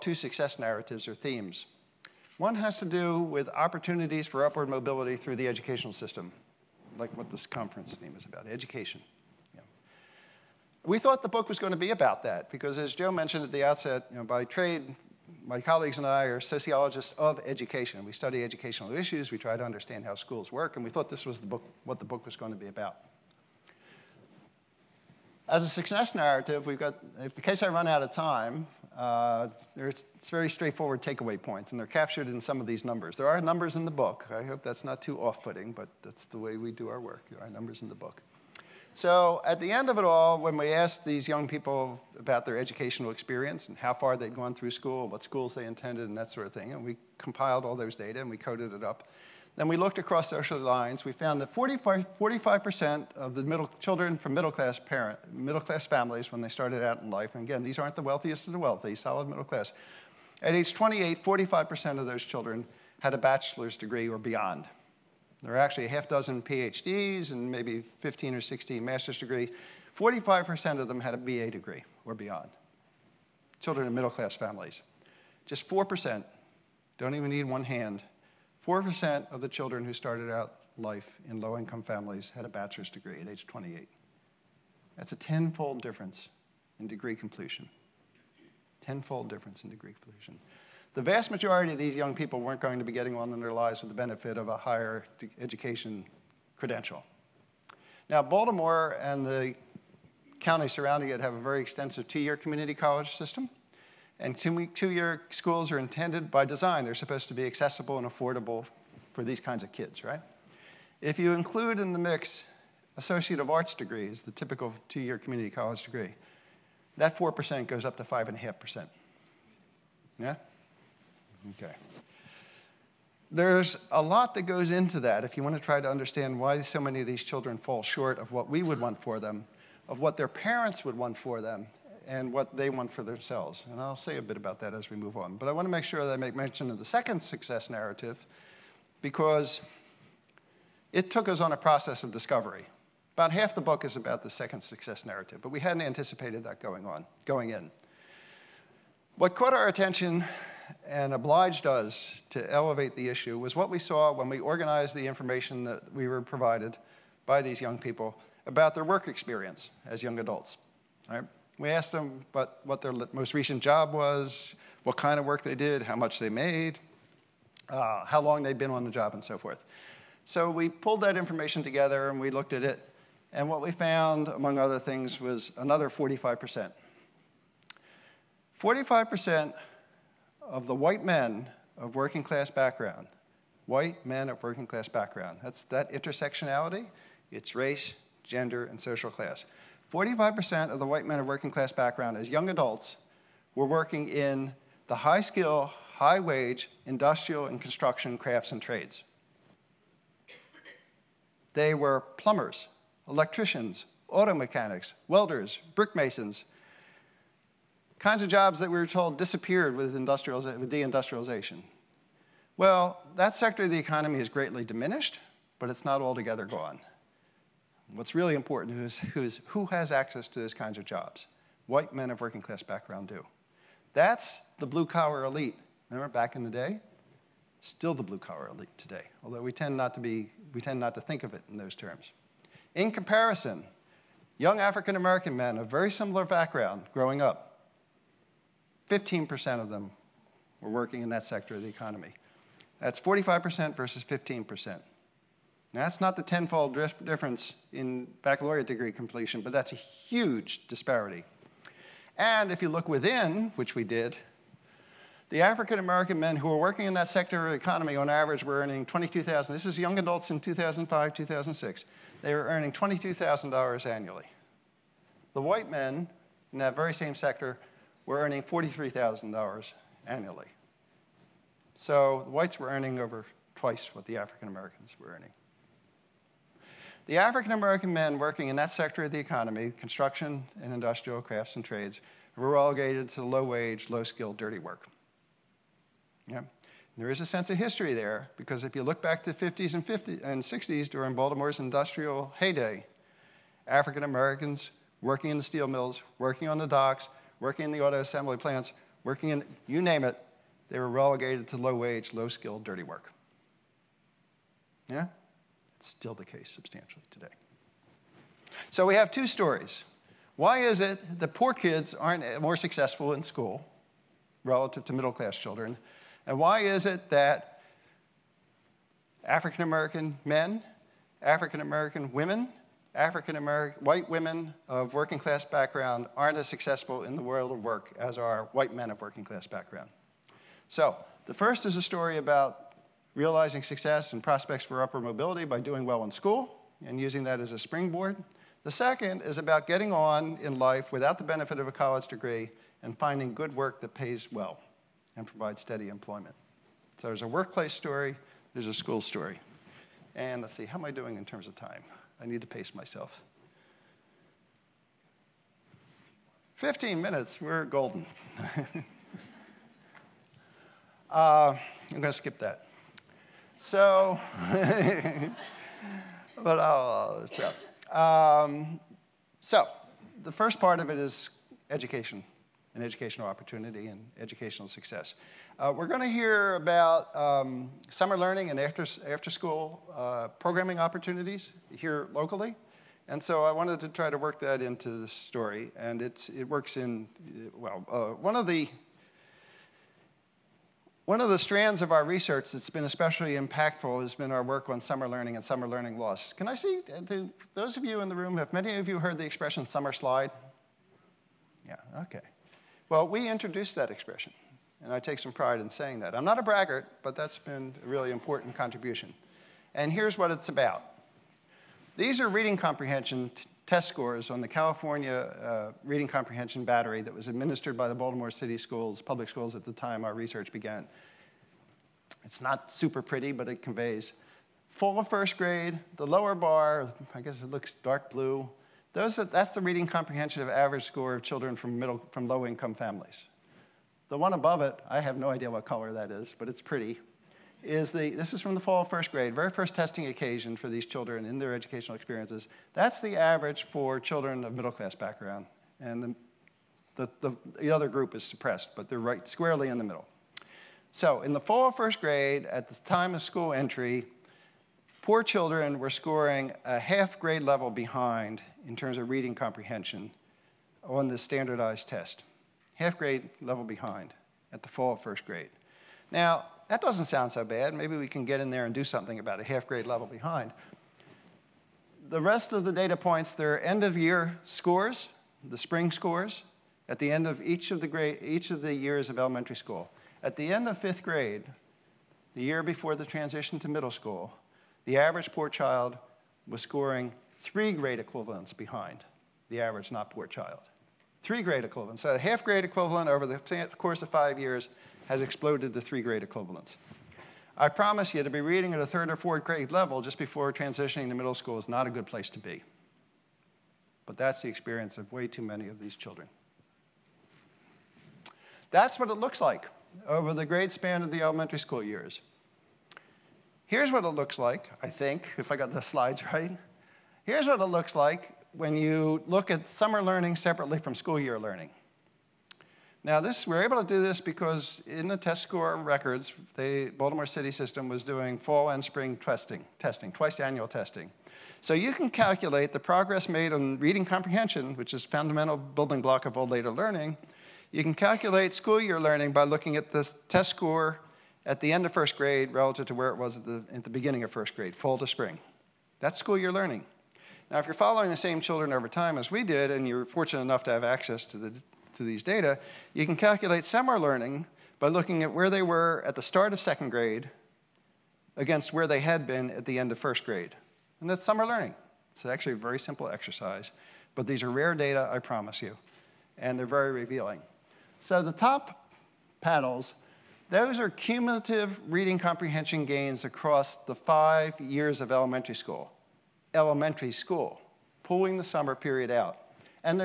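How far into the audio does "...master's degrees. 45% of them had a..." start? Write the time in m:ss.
1:08.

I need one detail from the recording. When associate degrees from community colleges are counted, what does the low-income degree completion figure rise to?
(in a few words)
5.5%.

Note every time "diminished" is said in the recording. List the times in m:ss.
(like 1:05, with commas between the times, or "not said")
3:34.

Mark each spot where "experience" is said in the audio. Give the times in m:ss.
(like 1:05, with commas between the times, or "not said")
0:43, 2:39, 7:21, 8:24.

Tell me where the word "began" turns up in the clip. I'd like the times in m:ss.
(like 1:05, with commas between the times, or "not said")
7:00.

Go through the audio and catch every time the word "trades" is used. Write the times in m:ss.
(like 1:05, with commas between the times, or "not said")
0:14, 3:18, 4:41.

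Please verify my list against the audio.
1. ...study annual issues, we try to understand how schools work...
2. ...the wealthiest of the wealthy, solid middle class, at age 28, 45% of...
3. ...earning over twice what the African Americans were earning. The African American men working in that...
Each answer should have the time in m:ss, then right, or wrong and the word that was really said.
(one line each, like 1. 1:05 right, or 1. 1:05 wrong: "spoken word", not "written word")
1. 0:18 wrong: "educational", not "annual"
2. 0:57 right
3. 4:32 right.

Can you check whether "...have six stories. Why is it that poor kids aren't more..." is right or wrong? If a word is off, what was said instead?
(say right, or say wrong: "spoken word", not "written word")
wrong: "two", not "six".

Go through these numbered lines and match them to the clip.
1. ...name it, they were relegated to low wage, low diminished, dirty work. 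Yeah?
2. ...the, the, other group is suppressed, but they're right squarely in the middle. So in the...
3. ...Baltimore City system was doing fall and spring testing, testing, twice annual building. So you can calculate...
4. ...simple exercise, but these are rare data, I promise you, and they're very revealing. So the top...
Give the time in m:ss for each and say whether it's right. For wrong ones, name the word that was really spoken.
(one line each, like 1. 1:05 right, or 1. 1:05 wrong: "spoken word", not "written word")
1. 4:59 wrong: "skilled", not "diminished"
2. 7:27 right
3. 8:46 wrong: "testing", not "building"
4. 9:22 right.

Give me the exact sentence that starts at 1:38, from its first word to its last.
Now, Baltimore and the county surrounding it have a very extensive two-year community college system.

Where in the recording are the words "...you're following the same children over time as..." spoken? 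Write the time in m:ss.
9:07.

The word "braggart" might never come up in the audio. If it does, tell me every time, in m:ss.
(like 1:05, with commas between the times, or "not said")
6:46.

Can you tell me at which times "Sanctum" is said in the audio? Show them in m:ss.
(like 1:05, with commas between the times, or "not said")
not said.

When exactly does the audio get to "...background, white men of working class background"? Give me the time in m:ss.
3:02.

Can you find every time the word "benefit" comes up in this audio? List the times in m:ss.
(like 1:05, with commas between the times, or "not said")
1:33, 5:41.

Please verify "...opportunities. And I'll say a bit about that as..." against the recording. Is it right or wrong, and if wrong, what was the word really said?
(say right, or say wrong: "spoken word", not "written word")
wrong: "themselves", not "opportunities".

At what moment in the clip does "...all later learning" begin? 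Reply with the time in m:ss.
8:56.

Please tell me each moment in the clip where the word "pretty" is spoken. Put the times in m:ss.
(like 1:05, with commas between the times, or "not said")
7:03, 7:16.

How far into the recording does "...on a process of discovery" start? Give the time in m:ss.
2:21.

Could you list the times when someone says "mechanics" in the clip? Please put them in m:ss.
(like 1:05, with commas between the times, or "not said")
3:24.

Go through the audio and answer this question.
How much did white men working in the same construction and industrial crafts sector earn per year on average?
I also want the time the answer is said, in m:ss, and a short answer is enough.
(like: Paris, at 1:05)
$43,000, at 4:28.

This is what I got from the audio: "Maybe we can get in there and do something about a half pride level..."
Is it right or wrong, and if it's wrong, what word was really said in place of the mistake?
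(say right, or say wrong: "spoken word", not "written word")
wrong: "grade", not "pride".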